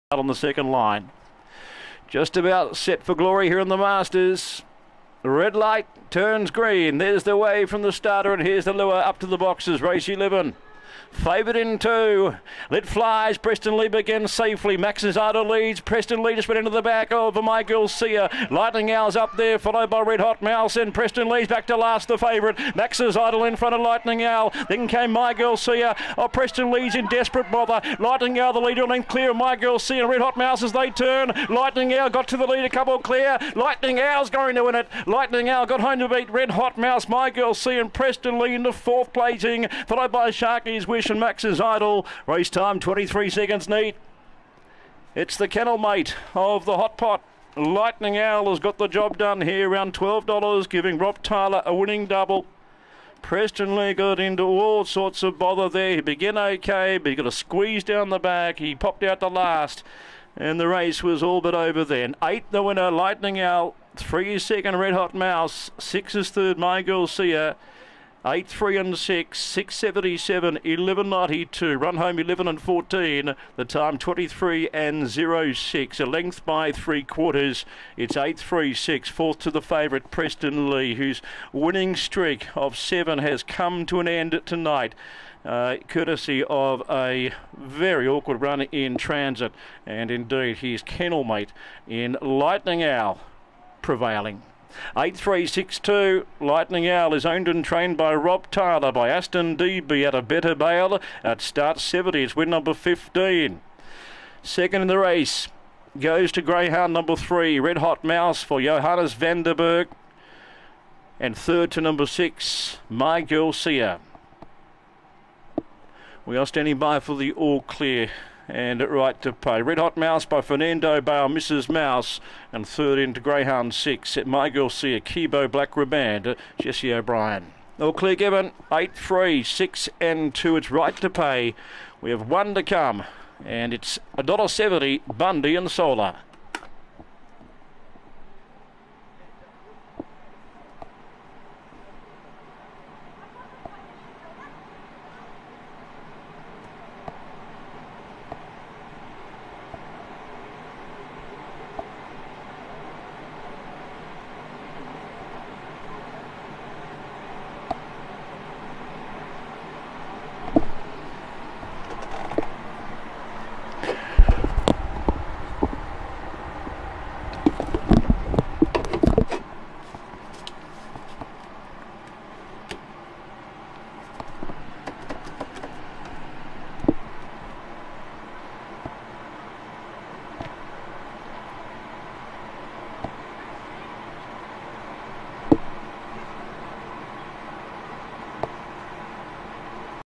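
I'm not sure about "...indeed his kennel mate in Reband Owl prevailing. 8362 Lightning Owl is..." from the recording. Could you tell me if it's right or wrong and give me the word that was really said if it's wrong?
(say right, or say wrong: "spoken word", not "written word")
wrong: "Lightning", not "Reband".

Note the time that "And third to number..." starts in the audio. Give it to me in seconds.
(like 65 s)
111 s.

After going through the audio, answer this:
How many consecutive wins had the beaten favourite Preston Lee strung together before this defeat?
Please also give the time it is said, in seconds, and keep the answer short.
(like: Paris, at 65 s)
7, at 82 s.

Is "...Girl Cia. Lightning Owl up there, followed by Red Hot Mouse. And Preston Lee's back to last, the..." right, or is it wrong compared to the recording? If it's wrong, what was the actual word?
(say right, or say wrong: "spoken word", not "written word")
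right.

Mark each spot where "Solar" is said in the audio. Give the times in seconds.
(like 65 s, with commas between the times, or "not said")
135 s.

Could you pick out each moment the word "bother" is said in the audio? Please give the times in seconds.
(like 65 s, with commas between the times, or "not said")
27 s, 55 s.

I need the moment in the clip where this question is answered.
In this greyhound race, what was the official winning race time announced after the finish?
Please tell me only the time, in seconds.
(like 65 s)
42 s.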